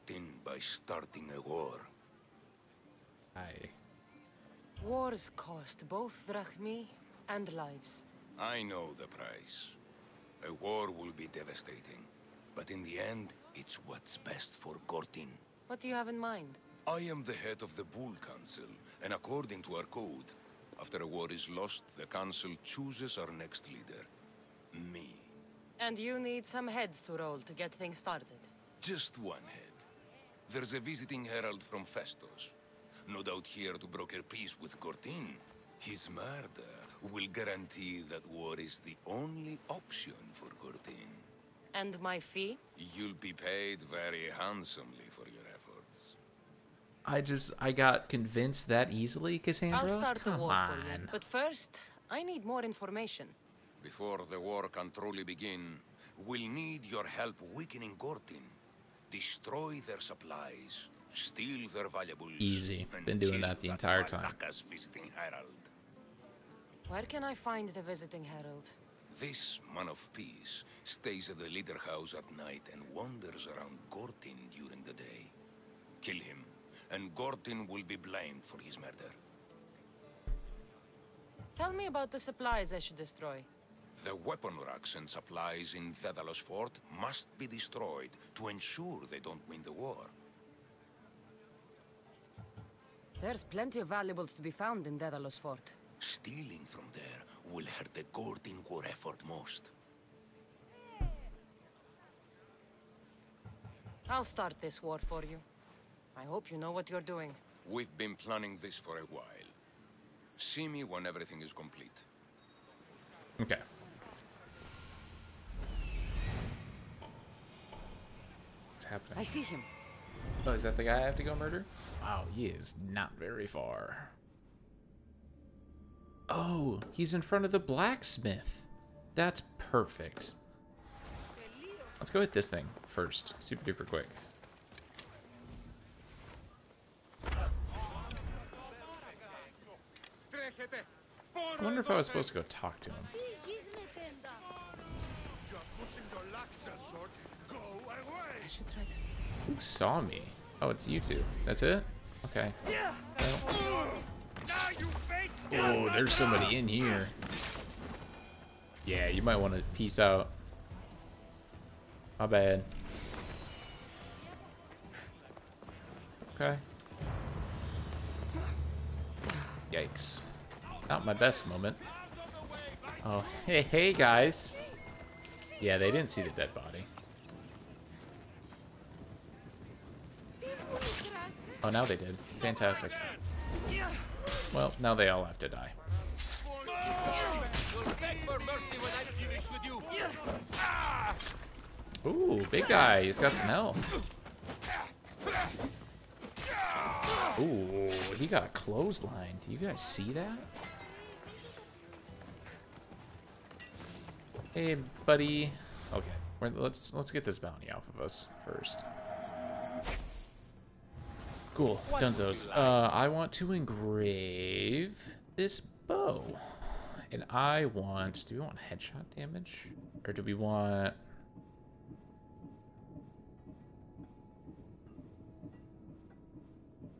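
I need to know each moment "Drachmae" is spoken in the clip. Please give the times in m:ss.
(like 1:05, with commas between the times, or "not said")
0:06.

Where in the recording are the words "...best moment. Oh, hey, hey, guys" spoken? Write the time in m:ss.
2:51.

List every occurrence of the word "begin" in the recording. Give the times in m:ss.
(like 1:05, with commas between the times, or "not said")
0:55.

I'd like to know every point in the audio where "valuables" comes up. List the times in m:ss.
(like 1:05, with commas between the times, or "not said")
1:01, 1:33.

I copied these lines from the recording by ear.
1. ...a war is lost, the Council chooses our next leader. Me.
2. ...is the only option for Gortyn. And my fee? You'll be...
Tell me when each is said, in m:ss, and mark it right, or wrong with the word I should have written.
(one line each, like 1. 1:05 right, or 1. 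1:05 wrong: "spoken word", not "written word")
1. 0:21 right
2. 0:38 right.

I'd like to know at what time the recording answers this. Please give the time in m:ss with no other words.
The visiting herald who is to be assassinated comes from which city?
0:31.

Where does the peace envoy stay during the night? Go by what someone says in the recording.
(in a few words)
the leader house.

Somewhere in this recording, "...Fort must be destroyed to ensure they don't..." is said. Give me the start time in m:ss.
1:26.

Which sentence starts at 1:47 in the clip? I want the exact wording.
We've been planning this for a while.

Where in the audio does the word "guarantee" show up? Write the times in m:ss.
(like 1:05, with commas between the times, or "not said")
0:37.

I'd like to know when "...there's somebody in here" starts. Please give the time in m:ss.
2:35.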